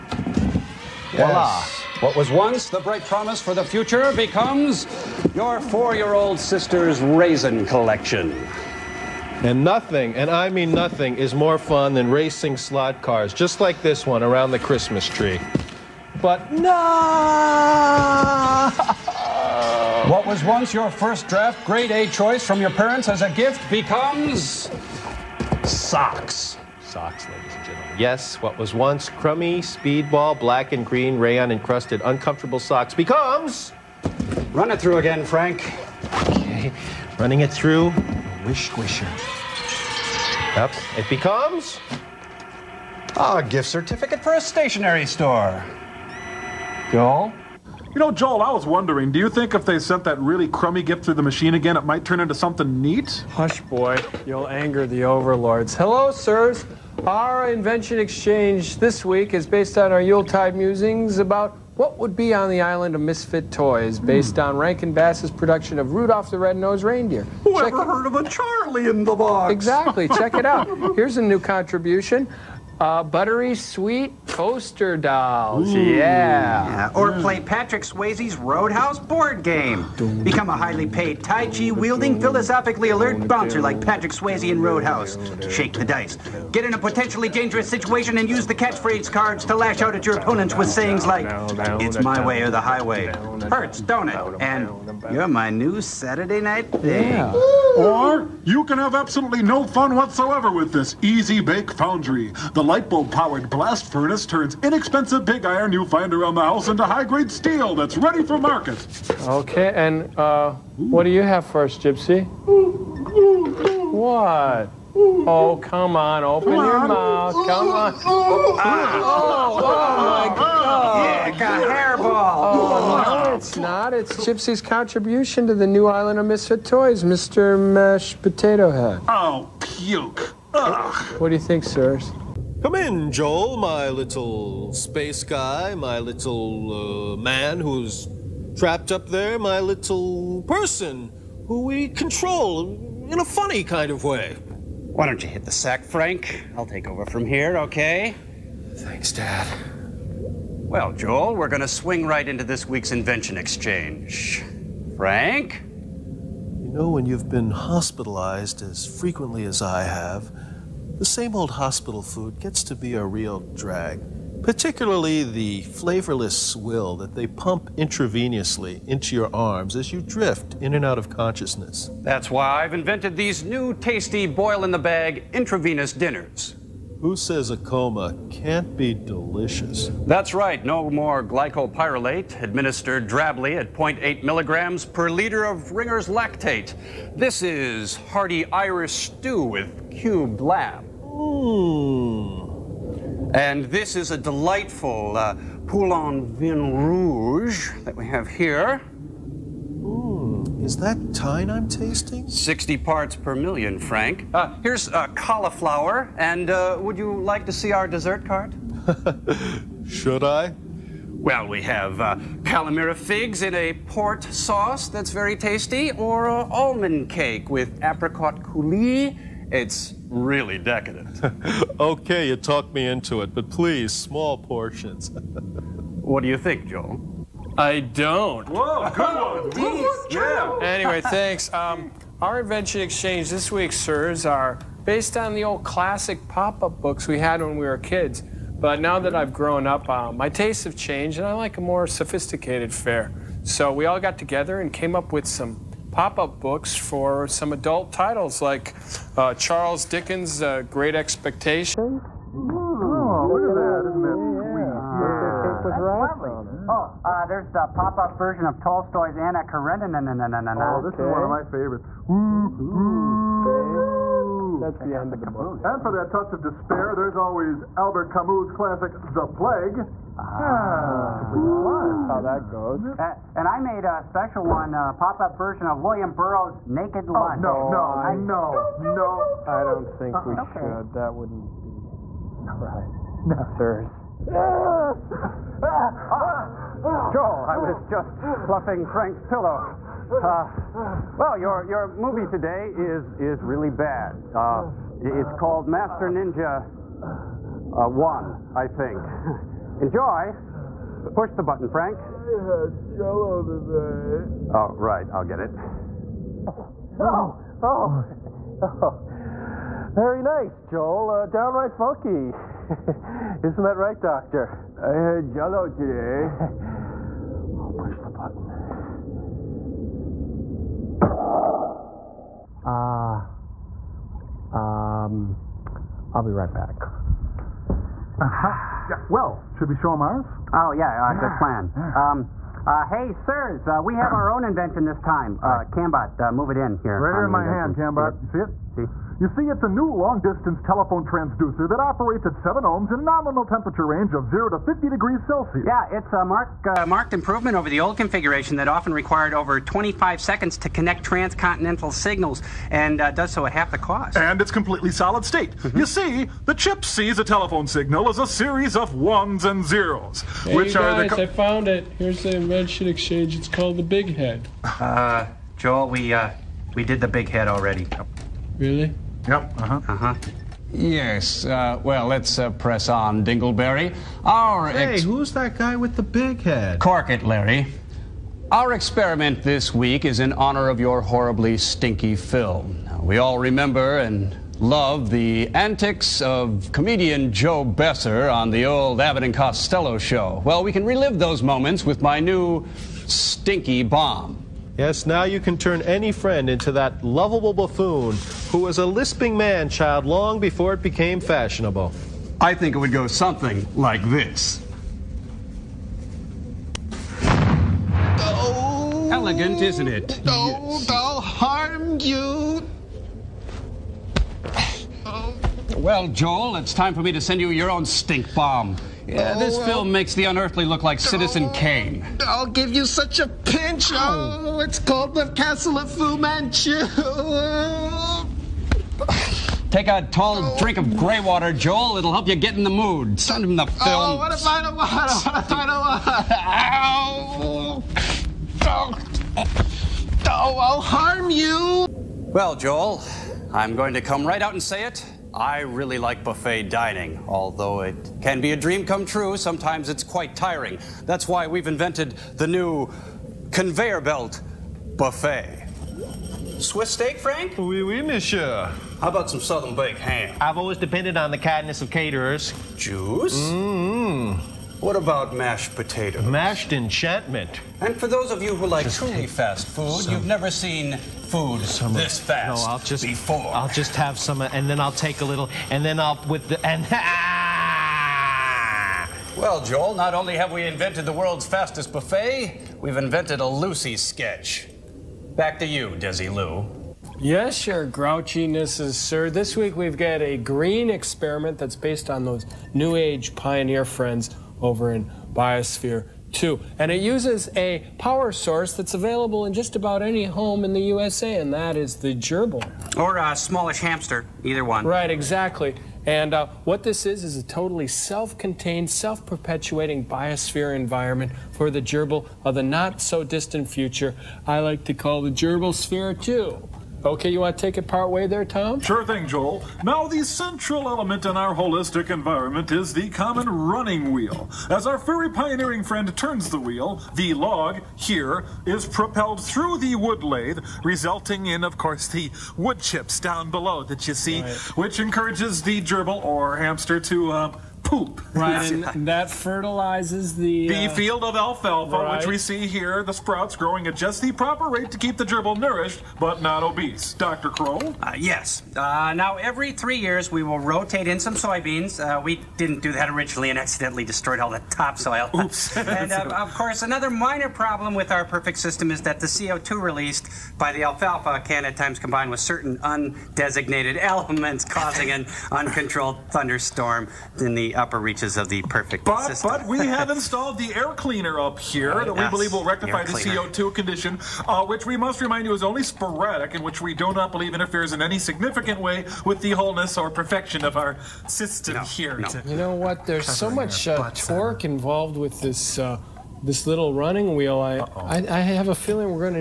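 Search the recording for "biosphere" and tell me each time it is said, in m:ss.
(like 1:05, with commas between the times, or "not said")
8:15, 8:30.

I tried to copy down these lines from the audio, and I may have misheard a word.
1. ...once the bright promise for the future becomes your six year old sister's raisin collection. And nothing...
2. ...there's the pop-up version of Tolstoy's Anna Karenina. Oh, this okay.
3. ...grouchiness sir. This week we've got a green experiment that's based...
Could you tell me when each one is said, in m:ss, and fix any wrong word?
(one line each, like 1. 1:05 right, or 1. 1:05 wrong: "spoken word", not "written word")
1. 0:02 wrong: "four", not "six"
2. 4:17 right
3. 8:07 right.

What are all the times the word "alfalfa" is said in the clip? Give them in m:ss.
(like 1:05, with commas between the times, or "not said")
9:01, 9:20.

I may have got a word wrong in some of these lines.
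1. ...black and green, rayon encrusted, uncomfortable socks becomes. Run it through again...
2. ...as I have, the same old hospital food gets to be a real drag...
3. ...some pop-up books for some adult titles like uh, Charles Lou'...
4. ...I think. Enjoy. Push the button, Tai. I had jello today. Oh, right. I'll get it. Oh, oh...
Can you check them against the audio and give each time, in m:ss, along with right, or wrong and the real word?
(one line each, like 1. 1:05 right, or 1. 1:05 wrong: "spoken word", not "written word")
1. 0:30 right
2. 2:39 right
3. 4:05 wrong: "Dickens", not "Lou"
4. 4:58 wrong: "Frank", not "Tai".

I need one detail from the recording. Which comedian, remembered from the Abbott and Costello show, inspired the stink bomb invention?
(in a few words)
Joe Besser.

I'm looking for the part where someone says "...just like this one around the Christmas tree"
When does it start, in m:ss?
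0:13.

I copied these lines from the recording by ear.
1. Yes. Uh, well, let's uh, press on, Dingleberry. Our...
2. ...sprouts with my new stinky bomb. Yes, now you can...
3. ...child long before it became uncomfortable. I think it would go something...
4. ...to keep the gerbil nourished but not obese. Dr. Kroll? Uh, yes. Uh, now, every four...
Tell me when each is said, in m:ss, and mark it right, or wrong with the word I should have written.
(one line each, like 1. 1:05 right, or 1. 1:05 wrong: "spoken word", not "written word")
1. 6:10 right
2. 6:31 wrong: "moments", not "sprouts"
3. 6:39 wrong: "fashionable", not "uncomfortable"
4. 9:04 wrong: "three", not "four".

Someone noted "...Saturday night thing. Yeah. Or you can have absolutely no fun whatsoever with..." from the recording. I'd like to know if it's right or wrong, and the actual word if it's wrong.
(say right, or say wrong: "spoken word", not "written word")
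right.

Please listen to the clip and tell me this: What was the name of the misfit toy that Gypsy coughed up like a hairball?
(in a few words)
Mr. Mash Potato Head.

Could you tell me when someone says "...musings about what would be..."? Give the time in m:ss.
1:00.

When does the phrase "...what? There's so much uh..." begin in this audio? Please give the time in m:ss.
9:42.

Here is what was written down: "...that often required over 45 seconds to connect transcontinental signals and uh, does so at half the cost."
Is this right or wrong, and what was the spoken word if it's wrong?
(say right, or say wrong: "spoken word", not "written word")
wrong: "25", not "45".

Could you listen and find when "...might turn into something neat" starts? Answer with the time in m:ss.
0:51.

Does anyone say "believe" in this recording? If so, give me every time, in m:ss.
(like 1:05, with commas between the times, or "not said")
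9:32, 9:37.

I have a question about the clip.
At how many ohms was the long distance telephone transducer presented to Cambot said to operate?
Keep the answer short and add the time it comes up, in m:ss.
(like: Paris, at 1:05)
7, at 5:42.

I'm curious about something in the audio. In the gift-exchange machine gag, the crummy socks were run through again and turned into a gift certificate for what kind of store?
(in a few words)
Stationery store.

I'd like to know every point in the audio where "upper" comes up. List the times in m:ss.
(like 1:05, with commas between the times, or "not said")
9:27.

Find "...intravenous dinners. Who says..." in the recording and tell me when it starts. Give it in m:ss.
2:55.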